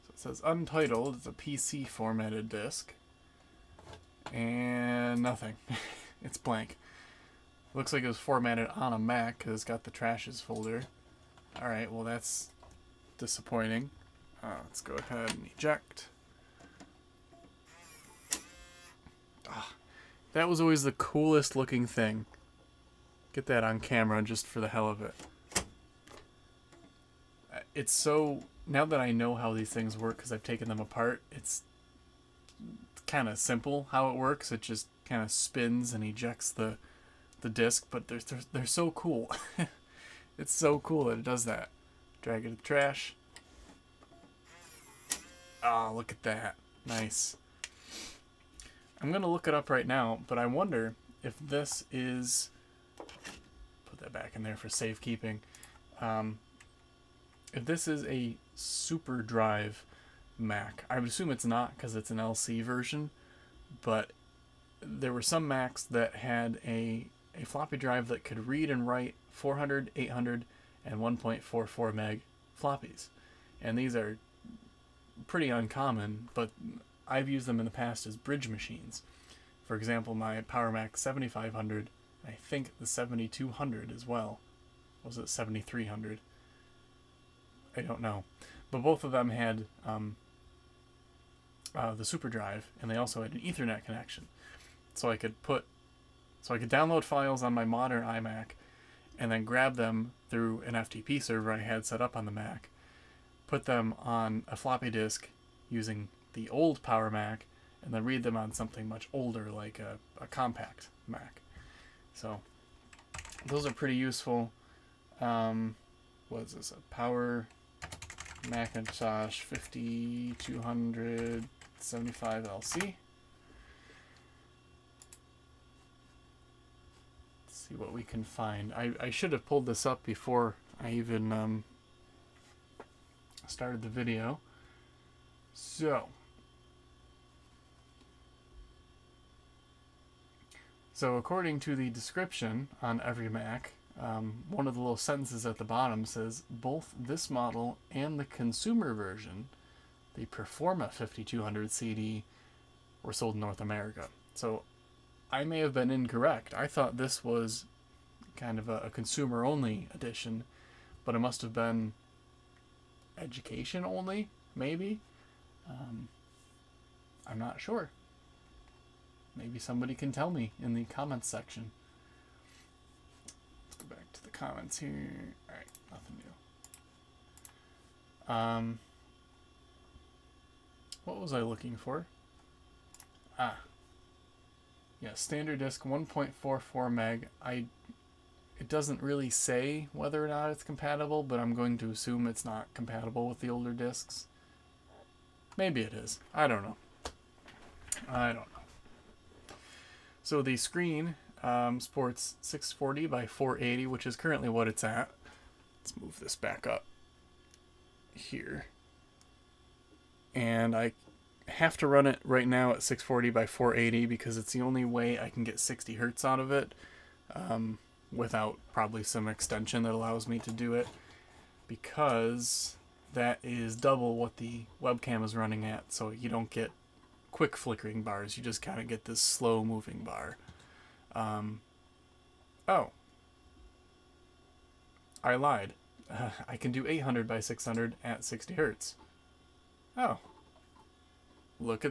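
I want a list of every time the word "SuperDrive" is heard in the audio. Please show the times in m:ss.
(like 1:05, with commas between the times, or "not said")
0:58, 1:32.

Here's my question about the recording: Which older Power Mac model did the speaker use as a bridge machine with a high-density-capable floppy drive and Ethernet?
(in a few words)
PowerMac 7500.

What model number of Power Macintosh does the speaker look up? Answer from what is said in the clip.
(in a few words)
5275.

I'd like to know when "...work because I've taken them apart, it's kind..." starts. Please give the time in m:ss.
0:29.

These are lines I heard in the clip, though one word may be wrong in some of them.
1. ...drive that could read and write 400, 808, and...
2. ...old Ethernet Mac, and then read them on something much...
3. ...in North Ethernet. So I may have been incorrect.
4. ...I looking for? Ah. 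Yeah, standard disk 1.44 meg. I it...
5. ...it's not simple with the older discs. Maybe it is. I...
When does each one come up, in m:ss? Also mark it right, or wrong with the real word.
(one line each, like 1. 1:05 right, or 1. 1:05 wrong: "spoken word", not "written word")
1. 1:07 wrong: "800", not "808"
2. 1:46 wrong: "Power", not "Ethernet"
3. 2:33 wrong: "America", not "Ethernet"
4. 3:01 right
5. 3:12 wrong: "compatible", not "simple".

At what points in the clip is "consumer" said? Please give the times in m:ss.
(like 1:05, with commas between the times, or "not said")
2:28, 2:38.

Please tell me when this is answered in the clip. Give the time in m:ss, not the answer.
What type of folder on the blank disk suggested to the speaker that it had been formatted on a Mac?
0:09.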